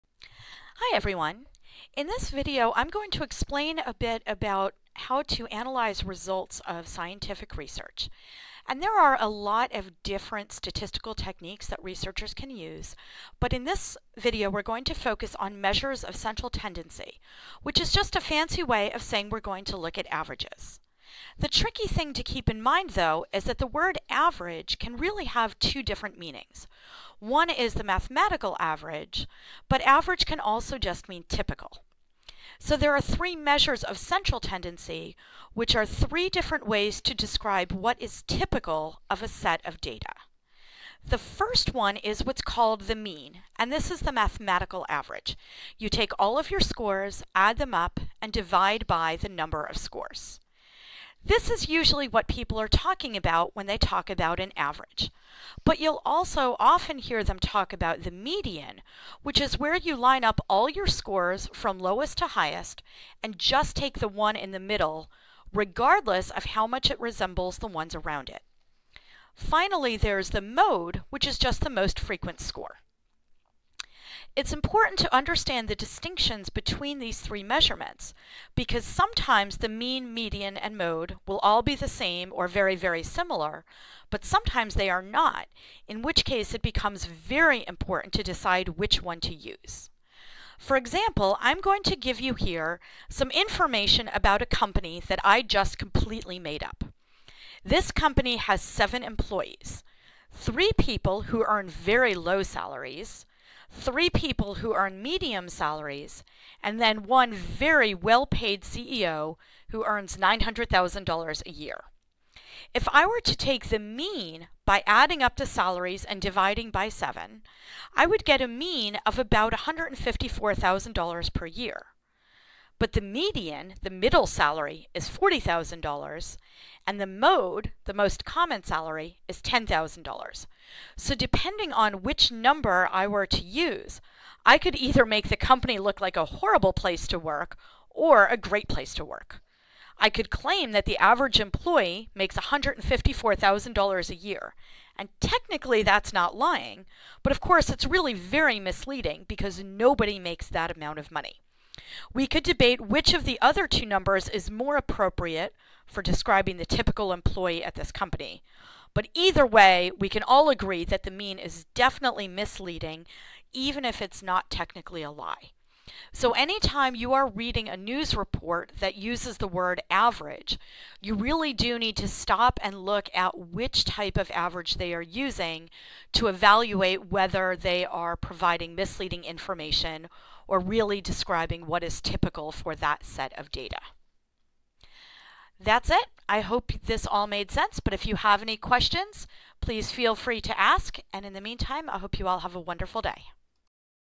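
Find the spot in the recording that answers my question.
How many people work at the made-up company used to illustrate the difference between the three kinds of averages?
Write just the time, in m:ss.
1:38.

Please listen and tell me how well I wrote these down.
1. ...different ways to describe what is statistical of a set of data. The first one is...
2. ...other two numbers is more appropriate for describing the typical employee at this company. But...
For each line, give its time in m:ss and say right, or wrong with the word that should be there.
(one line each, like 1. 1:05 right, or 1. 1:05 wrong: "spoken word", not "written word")
1. 0:36 wrong: "typical", not "statistical"
2. 2:33 right.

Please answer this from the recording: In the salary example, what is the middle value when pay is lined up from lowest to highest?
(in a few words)
$40,000.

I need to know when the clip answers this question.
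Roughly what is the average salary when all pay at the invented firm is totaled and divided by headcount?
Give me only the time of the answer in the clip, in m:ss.
1:59.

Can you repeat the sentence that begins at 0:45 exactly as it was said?
You take all of your scores, add them up, and divide by the number of scores.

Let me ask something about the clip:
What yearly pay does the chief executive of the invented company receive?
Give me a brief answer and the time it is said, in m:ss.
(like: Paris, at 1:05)
$900,000, at 1:50.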